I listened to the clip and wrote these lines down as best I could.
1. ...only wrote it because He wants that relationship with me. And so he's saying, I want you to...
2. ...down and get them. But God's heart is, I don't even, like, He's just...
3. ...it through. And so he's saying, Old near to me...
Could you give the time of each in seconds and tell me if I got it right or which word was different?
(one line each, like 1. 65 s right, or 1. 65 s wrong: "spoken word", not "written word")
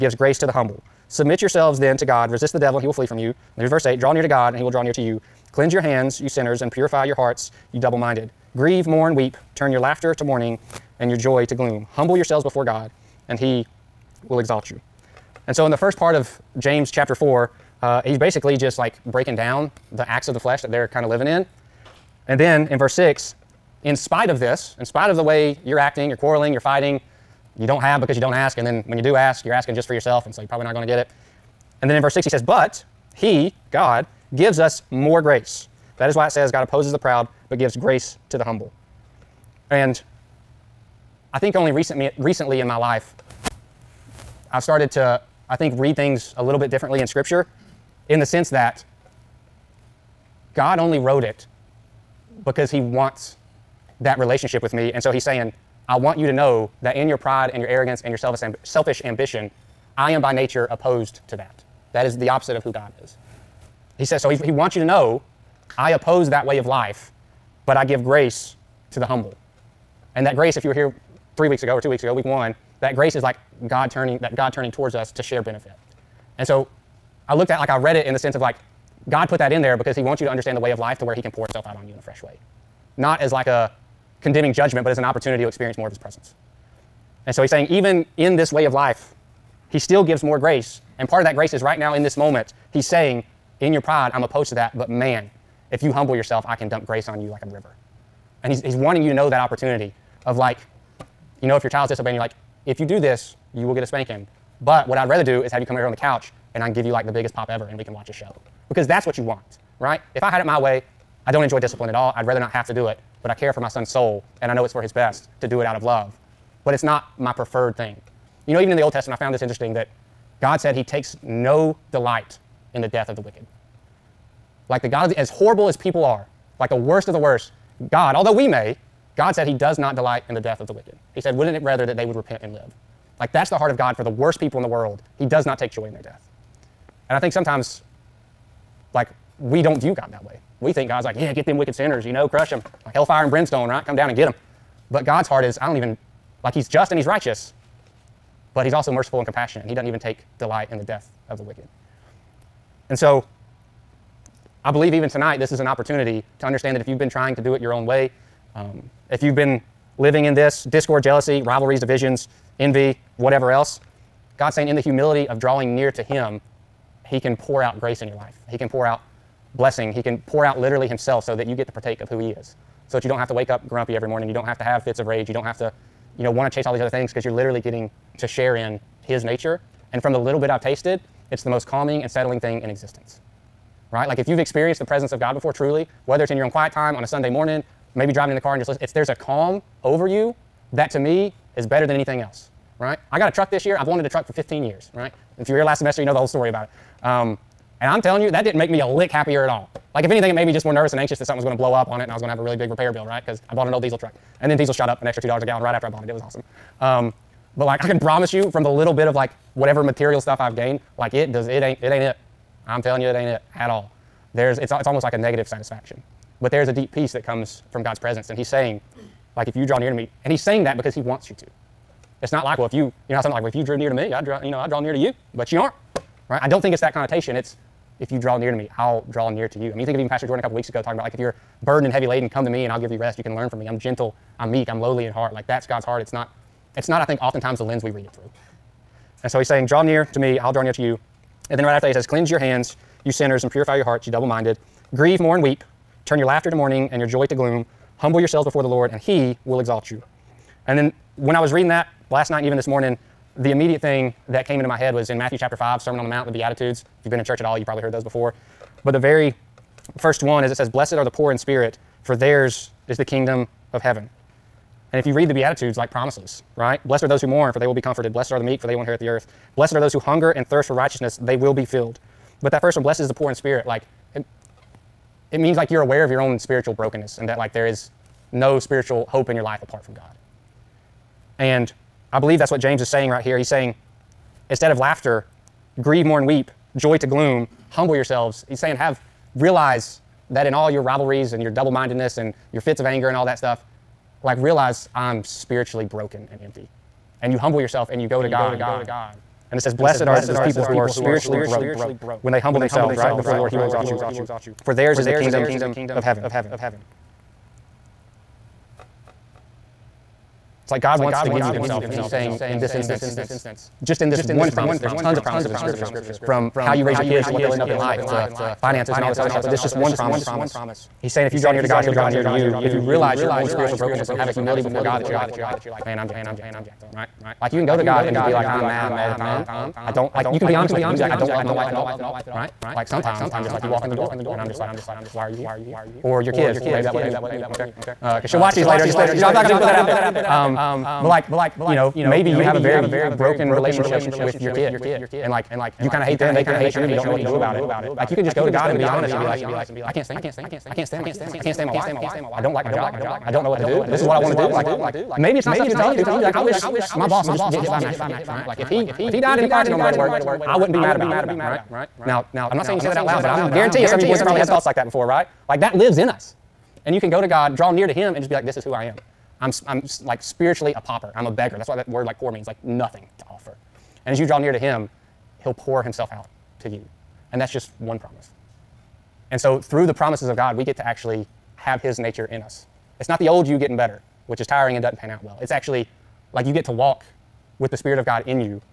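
1. 50 s right
2. 143 s right
3. 238 s wrong: "Draw", not "Old".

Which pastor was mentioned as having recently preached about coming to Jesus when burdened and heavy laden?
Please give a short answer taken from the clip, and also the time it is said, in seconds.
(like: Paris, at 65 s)
Pastor Jordan, at 230 s.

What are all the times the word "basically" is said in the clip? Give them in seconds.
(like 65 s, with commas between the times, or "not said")
18 s.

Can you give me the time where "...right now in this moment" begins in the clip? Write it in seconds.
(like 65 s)
91 s.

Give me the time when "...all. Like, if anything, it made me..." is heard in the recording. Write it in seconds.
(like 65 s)
199 s.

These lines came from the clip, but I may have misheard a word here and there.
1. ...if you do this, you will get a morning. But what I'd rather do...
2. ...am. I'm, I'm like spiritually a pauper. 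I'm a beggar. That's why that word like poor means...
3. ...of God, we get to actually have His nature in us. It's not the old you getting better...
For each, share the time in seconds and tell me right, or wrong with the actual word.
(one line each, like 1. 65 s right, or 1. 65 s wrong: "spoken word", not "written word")
1. 102 s wrong: "spanking", not "morning"
2. 368 s right
3. 380 s right.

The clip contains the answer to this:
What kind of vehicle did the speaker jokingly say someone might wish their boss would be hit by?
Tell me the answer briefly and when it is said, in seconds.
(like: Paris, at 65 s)
Mack truck, at 357 s.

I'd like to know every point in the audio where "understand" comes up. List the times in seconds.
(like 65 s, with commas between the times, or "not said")
80 s, 156 s.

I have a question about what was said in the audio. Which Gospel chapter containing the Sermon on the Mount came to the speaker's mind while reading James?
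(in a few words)
Matthew chapter 5.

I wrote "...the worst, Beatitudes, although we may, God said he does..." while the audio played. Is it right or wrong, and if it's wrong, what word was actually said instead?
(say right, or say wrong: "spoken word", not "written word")
wrong: "God", not "Beatitudes".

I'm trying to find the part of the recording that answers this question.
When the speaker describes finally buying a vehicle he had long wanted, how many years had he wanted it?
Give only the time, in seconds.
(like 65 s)
194 s.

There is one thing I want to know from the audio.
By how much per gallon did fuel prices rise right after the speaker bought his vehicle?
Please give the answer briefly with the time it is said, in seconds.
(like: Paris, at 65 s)
$2, at 205 s.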